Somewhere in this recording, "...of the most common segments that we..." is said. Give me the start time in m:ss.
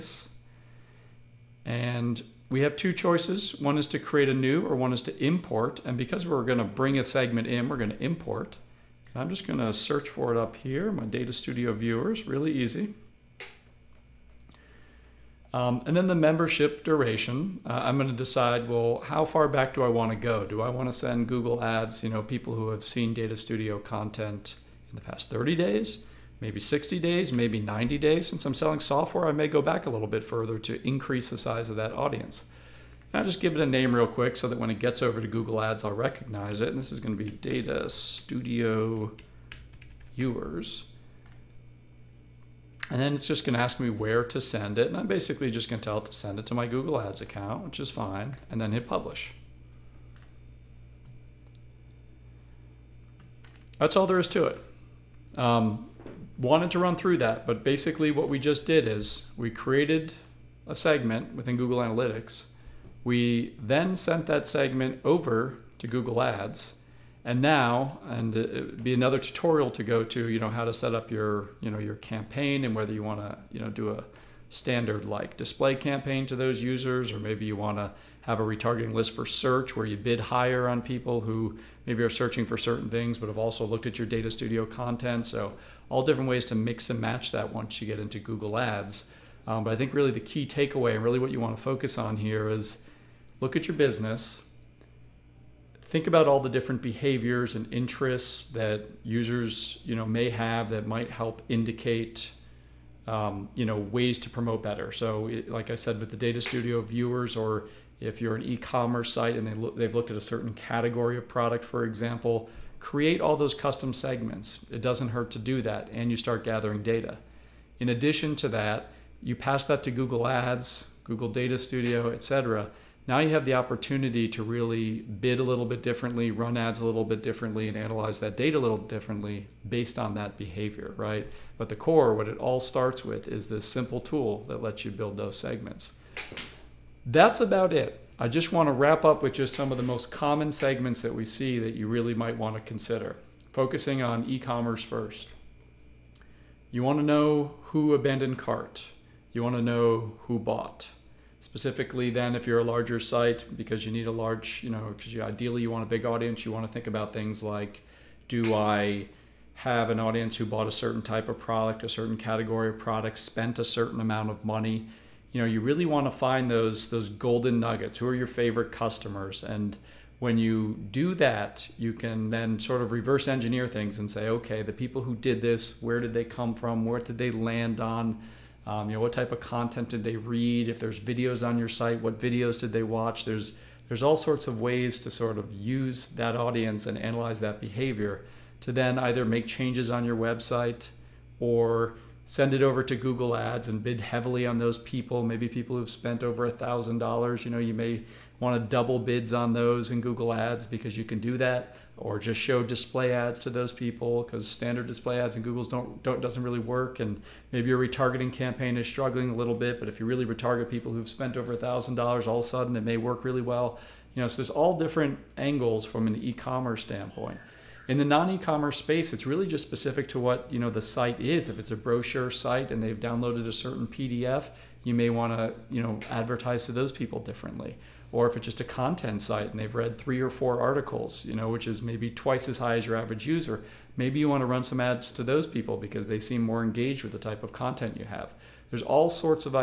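2:19.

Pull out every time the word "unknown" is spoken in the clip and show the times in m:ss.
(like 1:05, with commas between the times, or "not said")
not said.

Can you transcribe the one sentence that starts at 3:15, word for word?
Maybe people who've spent over a thousand dollars.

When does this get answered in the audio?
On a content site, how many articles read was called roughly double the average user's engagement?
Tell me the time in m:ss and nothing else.
3:49.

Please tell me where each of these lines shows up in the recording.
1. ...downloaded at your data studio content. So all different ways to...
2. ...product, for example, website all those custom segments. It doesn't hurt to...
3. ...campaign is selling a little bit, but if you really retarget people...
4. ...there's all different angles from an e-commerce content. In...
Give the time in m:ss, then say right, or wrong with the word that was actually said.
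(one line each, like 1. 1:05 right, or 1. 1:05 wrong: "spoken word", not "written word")
1. 1:23 wrong: "looked", not "downloaded"
2. 1:51 wrong: "create", not "website"
3. 3:28 wrong: "struggling", not "selling"
4. 3:34 wrong: "standpoint", not "content".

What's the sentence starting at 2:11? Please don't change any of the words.
But the core, what it all starts with, is this simple tool that lets you build those segments.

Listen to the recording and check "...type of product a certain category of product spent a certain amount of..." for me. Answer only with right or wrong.
right.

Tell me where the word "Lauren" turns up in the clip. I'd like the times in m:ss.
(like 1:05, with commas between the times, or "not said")
not said.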